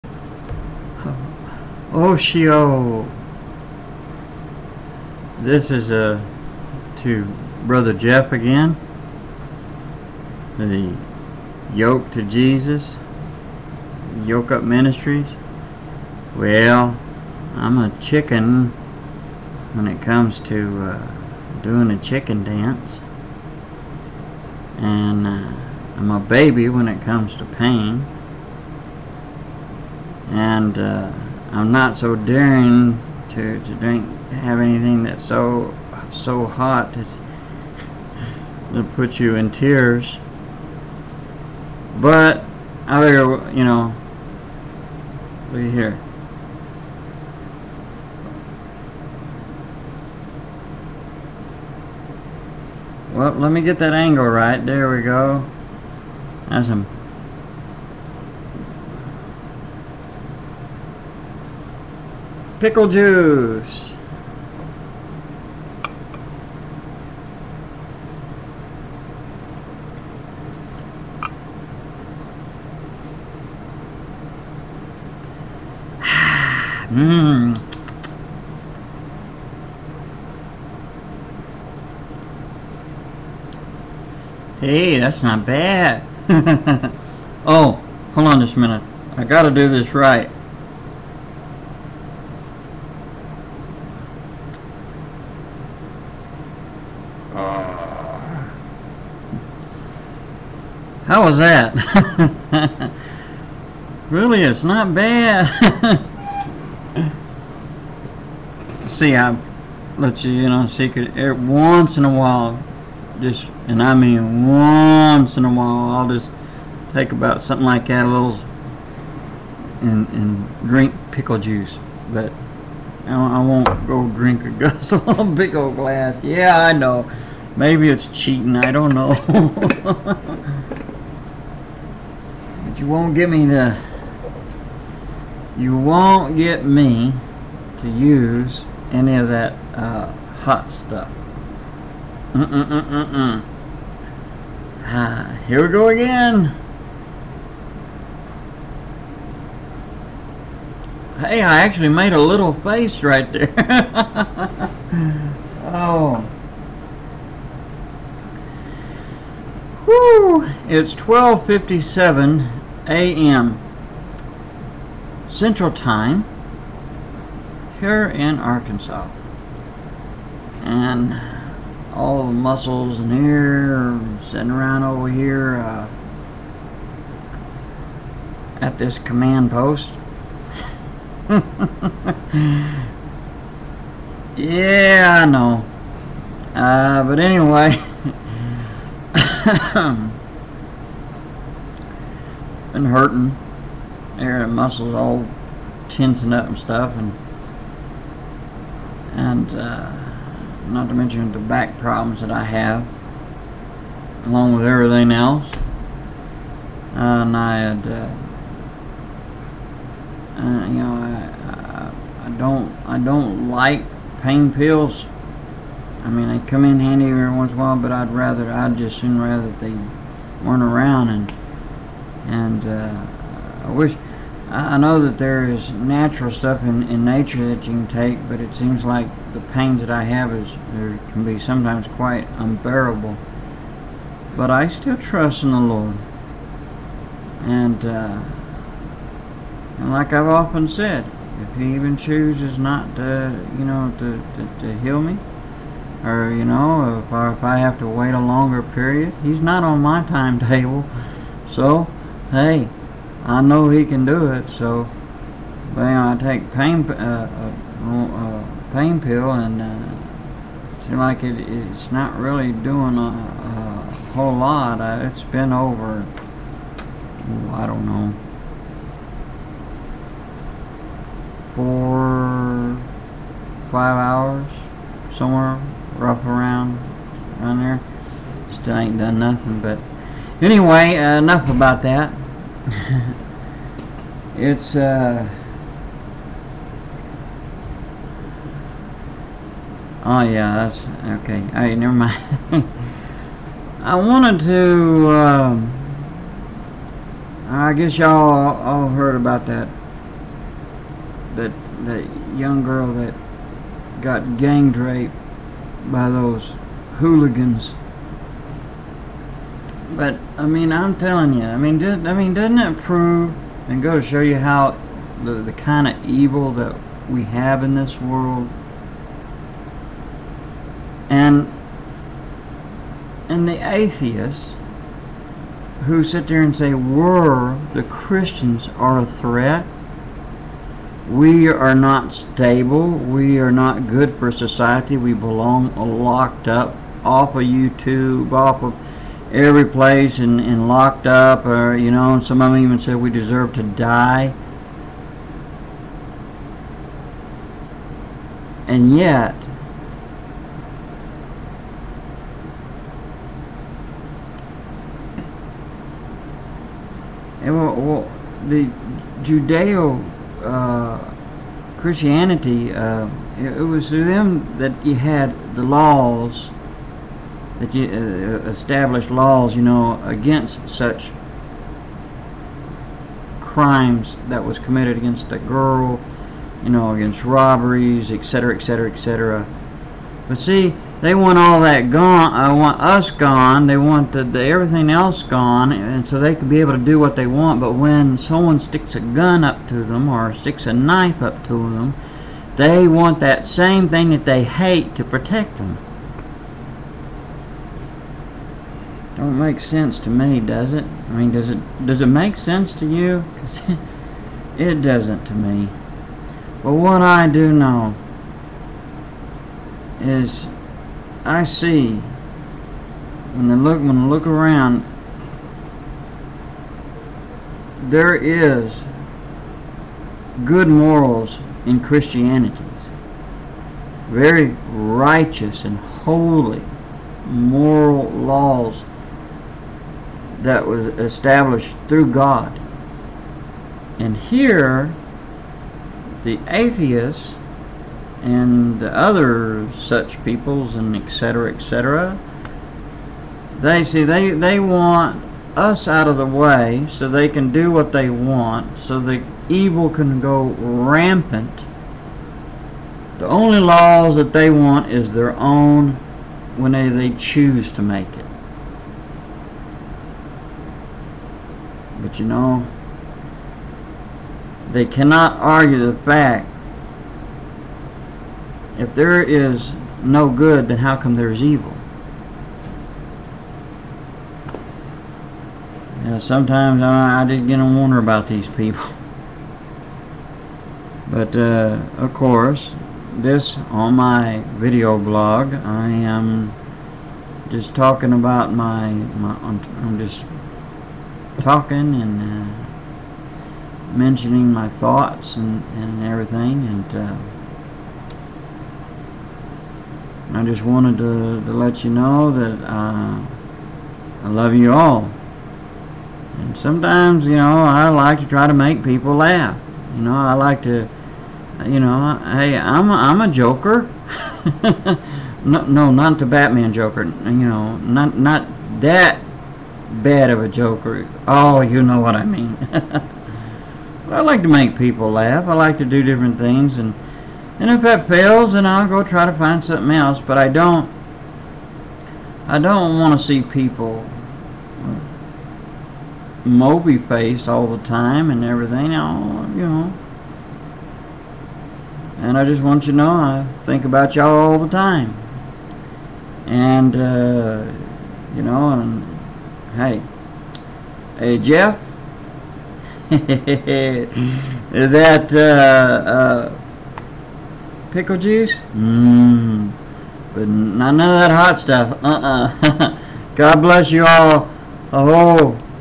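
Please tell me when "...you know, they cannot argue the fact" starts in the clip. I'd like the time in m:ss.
7:42.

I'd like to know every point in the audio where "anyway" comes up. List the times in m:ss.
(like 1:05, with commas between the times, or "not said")
3:07, 4:40.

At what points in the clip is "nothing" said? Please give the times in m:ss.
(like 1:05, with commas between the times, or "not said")
4:39.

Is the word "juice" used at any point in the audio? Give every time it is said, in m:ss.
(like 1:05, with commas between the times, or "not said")
1:02, 2:01, 9:18.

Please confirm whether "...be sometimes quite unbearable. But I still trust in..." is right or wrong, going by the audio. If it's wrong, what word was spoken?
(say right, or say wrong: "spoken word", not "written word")
right.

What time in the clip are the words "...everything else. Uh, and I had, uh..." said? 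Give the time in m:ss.
3:24.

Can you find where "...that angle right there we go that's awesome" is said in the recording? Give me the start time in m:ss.
0:53.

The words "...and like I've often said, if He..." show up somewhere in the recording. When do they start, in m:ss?
3:59.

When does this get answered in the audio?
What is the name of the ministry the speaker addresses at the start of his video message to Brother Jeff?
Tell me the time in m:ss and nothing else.
0:14.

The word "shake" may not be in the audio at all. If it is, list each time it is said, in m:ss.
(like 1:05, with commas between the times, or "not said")
not said.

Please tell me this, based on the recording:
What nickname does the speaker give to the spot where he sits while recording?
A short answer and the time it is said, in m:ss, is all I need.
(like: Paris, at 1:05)
command post, at 2:58.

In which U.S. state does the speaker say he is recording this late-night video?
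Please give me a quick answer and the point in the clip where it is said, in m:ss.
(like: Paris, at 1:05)
Arkansas, at 2:48.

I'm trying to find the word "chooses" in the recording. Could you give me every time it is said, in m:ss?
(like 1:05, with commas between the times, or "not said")
4:01, 7:37.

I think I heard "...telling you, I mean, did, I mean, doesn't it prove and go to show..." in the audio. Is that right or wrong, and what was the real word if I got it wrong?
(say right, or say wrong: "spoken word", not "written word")
right.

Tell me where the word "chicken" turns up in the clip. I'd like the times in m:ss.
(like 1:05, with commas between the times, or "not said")
0:17, 0:21.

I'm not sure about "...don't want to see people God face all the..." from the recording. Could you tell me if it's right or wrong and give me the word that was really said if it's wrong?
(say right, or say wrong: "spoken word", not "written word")
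wrong: "Moby", not "God".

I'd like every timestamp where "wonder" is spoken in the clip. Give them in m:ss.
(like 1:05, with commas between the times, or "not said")
7:57.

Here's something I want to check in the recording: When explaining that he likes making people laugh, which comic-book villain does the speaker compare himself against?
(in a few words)
the Batman joker.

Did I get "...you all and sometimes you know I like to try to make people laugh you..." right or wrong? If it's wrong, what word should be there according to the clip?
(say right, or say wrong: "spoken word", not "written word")
right.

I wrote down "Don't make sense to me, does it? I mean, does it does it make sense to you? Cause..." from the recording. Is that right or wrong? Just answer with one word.
right.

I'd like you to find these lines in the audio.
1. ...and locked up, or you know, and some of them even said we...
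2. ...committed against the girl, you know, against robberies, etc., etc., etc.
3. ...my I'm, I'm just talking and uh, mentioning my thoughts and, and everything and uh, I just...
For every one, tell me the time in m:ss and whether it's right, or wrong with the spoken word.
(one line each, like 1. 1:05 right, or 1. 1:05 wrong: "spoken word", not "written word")
1. 5:40 right
2. 6:14 right
3. 8:08 right.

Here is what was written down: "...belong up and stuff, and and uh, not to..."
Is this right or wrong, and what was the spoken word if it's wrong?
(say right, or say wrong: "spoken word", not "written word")
wrong: "tensing", not "belong".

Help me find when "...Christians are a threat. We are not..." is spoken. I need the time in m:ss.
5:27.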